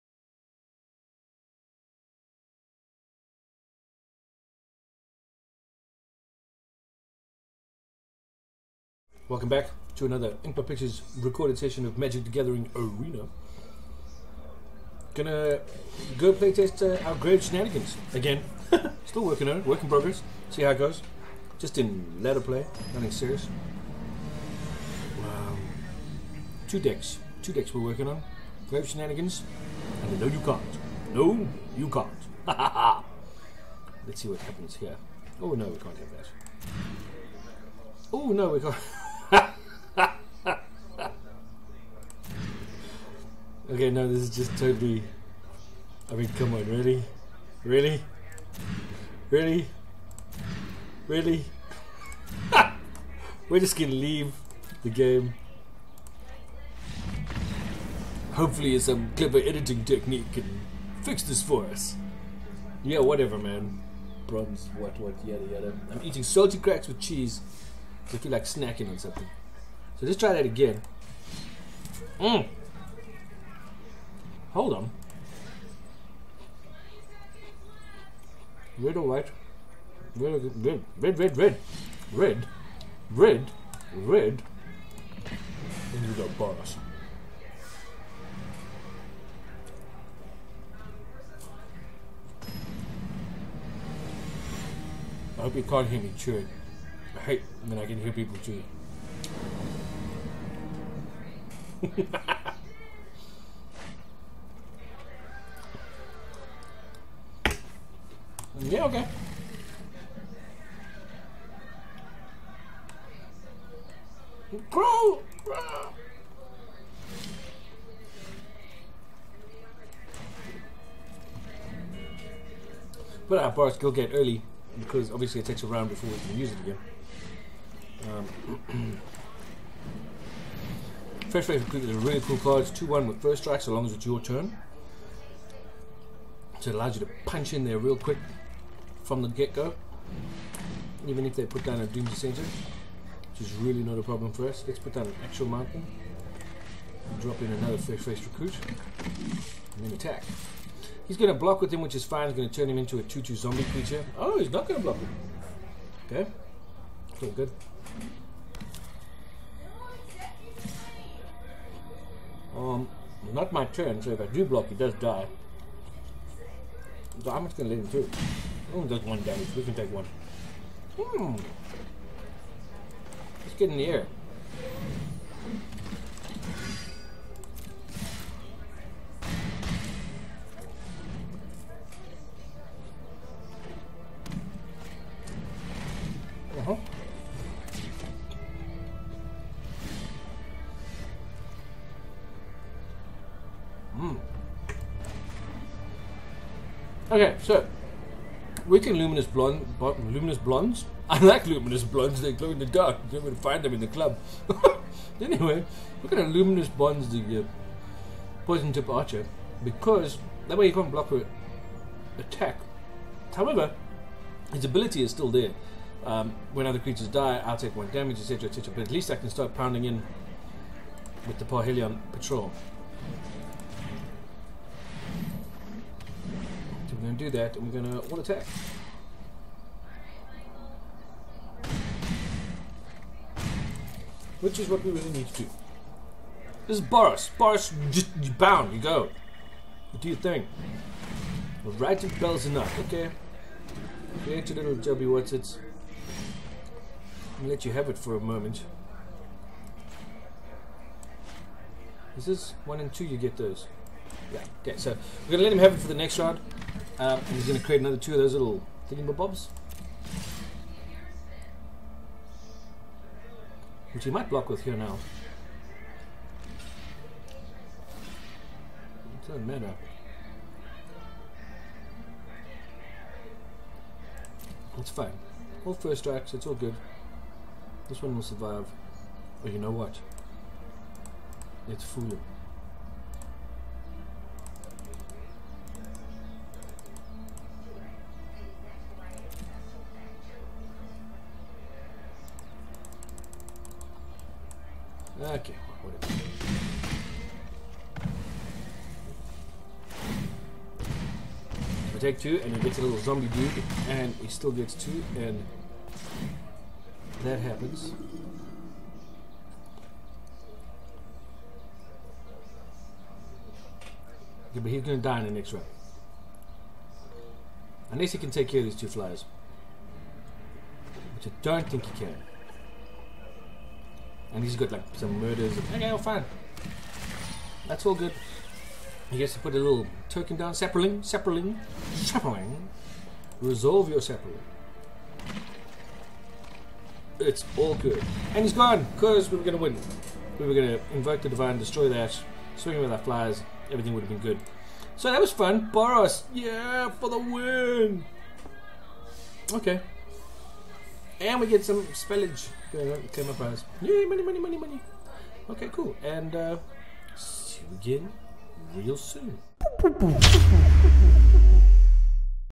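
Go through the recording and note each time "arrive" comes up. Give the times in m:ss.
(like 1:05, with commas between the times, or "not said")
not said.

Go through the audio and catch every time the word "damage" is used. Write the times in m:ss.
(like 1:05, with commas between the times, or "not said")
2:49, 3:37.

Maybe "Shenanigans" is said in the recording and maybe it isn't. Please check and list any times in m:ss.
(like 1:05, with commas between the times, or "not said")
0:17, 0:28.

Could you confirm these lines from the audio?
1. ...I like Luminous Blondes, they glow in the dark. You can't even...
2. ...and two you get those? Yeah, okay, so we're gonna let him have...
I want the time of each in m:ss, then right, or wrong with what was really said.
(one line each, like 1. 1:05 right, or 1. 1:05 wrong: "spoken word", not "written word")
1. 3:21 right
2. 4:12 right.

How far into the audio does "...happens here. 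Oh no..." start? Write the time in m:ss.
0:34.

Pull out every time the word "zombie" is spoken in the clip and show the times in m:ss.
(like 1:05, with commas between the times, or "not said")
2:33, 5:02.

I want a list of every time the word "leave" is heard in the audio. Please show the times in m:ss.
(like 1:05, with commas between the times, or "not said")
0:53.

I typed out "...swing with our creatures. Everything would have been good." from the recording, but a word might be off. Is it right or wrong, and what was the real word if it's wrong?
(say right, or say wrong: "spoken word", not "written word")
wrong: "flies", not "creatures".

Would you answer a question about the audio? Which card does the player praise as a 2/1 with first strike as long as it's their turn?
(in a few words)
Fresh Wave Recruit.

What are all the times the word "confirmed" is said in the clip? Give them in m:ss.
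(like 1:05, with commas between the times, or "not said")
not said.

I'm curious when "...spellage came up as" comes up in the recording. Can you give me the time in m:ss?
5:51.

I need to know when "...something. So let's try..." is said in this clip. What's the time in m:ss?
1:08.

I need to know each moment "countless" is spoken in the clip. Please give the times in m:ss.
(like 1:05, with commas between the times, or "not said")
not said.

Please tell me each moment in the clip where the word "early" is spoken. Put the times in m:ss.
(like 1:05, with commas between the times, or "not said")
2:04.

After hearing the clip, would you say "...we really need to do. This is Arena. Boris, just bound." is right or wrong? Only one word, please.
wrong.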